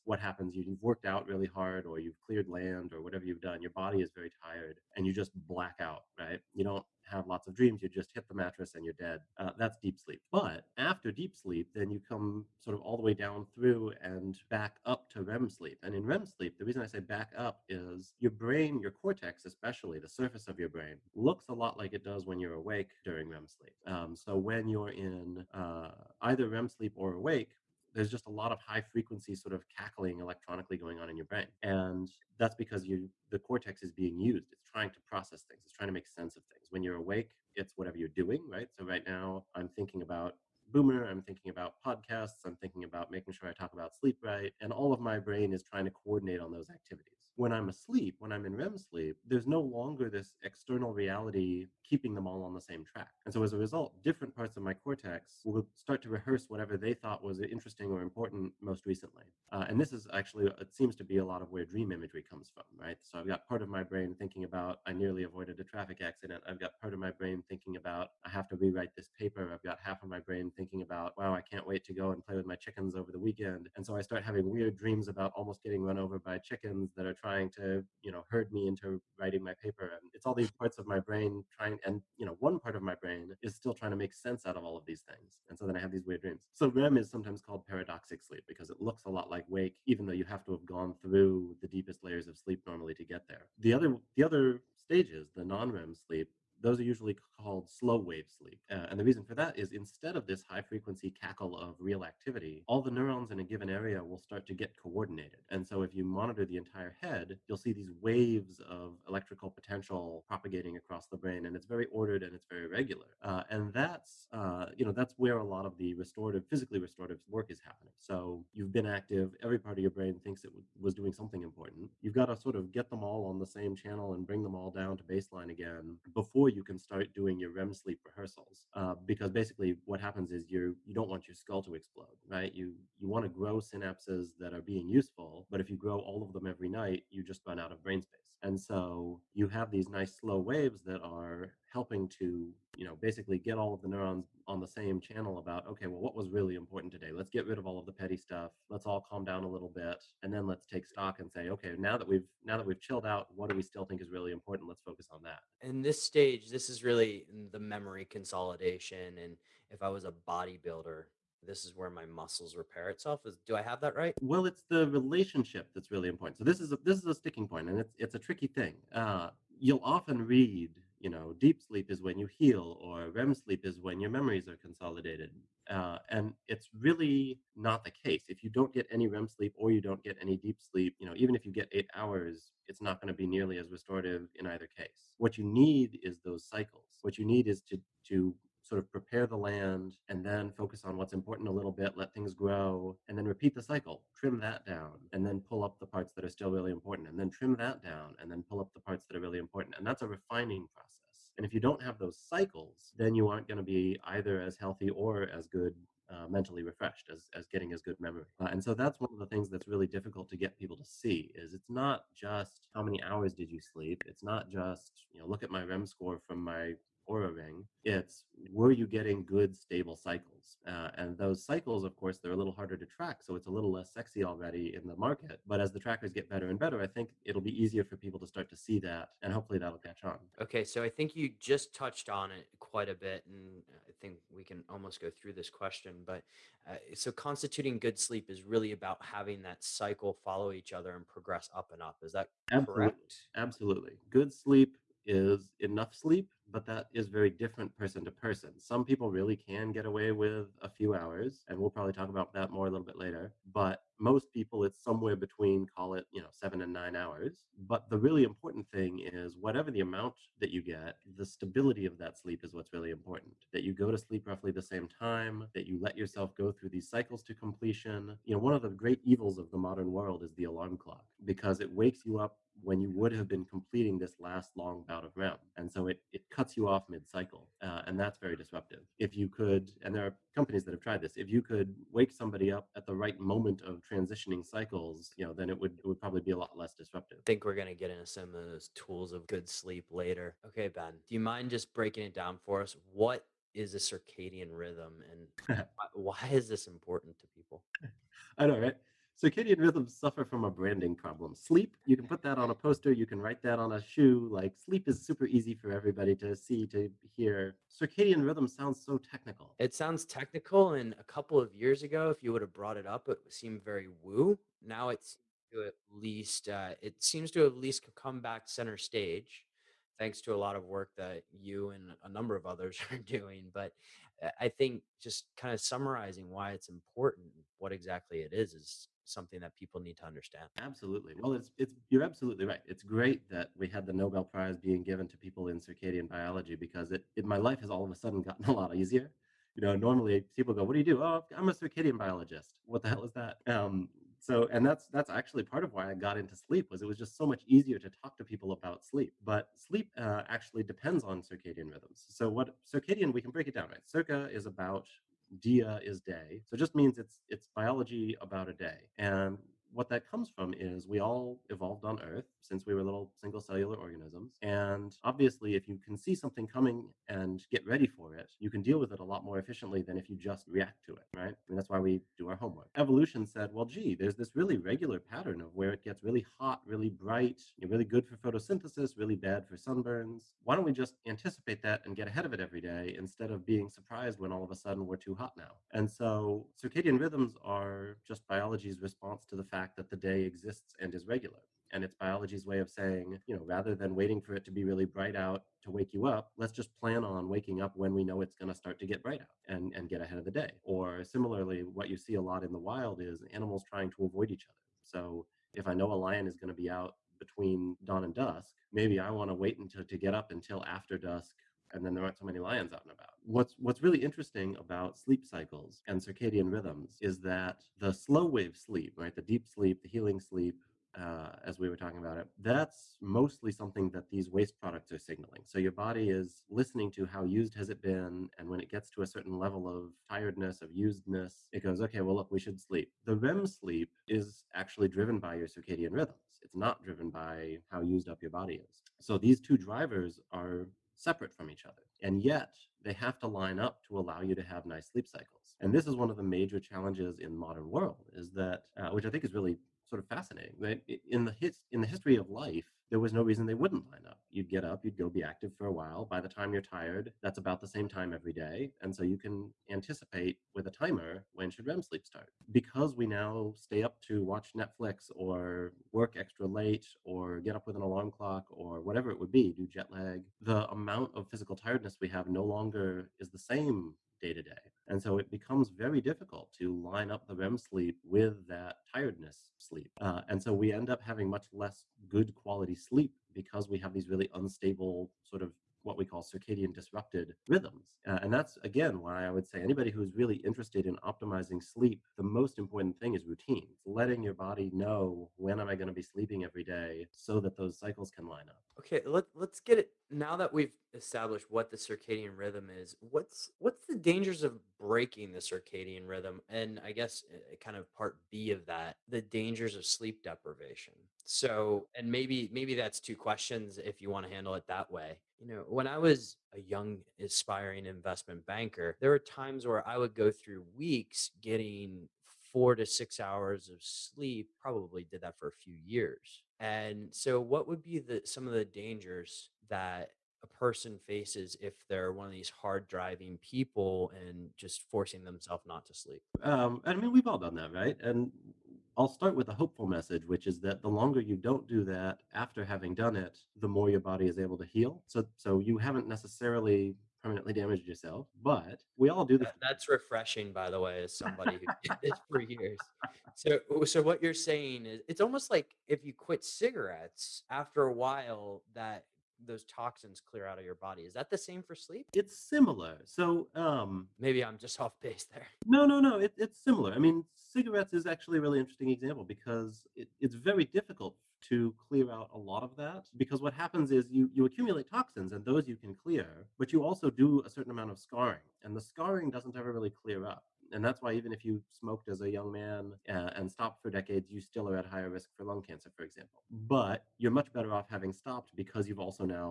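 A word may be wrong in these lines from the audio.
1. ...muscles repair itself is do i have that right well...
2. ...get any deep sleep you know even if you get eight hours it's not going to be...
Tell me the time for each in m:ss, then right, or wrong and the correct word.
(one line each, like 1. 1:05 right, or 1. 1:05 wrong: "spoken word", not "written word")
1. 2:42 right
2. 3:00 right.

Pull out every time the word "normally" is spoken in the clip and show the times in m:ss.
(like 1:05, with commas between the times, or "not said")
1:32, 5:39.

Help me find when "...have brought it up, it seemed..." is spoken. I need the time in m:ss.
5:12.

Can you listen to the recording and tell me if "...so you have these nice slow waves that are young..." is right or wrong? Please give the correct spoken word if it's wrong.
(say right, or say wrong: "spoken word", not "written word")
wrong: "helping", not "young".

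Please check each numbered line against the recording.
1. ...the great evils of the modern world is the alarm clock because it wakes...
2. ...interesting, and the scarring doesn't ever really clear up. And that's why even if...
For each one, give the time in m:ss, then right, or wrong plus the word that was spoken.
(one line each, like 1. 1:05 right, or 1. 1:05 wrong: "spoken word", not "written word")
1. 4:28 right
2. 9:37 wrong: "scarring", not "interesting".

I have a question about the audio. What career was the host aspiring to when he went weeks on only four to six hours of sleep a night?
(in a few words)
investment banker.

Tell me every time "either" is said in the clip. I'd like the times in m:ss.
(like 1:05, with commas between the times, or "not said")
0:26, 3:04, 3:24.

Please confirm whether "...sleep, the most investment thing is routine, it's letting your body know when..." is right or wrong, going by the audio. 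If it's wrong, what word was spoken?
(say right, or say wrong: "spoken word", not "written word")
wrong: "important", not "investment".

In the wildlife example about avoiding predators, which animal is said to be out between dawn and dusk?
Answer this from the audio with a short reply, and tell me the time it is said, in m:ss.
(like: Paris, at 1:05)
lion, at 6:46.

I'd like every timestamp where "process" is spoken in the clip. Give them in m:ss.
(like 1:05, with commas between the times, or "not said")
0:35, 3:20.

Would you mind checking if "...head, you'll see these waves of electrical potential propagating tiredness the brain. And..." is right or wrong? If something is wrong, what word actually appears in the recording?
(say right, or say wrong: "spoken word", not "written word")
wrong: "across", not "tiredness".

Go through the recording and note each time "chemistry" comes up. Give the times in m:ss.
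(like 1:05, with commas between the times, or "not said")
not said.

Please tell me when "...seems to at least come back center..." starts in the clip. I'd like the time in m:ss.
5:16.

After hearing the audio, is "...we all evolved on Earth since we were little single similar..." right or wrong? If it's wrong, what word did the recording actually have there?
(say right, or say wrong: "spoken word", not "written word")
wrong: "cellular", not "similar".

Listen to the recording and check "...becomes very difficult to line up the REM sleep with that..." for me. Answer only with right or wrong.
right.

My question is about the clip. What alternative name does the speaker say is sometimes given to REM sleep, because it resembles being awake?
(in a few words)
paradoxic sleep.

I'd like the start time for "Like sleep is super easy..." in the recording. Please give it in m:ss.
5:04.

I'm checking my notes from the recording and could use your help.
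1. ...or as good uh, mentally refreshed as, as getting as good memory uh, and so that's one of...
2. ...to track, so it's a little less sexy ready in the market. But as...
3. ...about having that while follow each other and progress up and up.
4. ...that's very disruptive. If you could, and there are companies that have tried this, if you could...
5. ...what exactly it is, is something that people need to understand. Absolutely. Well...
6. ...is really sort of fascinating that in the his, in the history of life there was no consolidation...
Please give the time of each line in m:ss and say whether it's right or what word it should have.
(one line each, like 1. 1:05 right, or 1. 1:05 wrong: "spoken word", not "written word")
1. 3:24 right
2. 3:42 wrong: "already", not "ready"
3. 3:58 wrong: "cycle", not "while"
4. 4:37 right
5. 5:27 right
6. 7:29 wrong: "reason", not "consolidation".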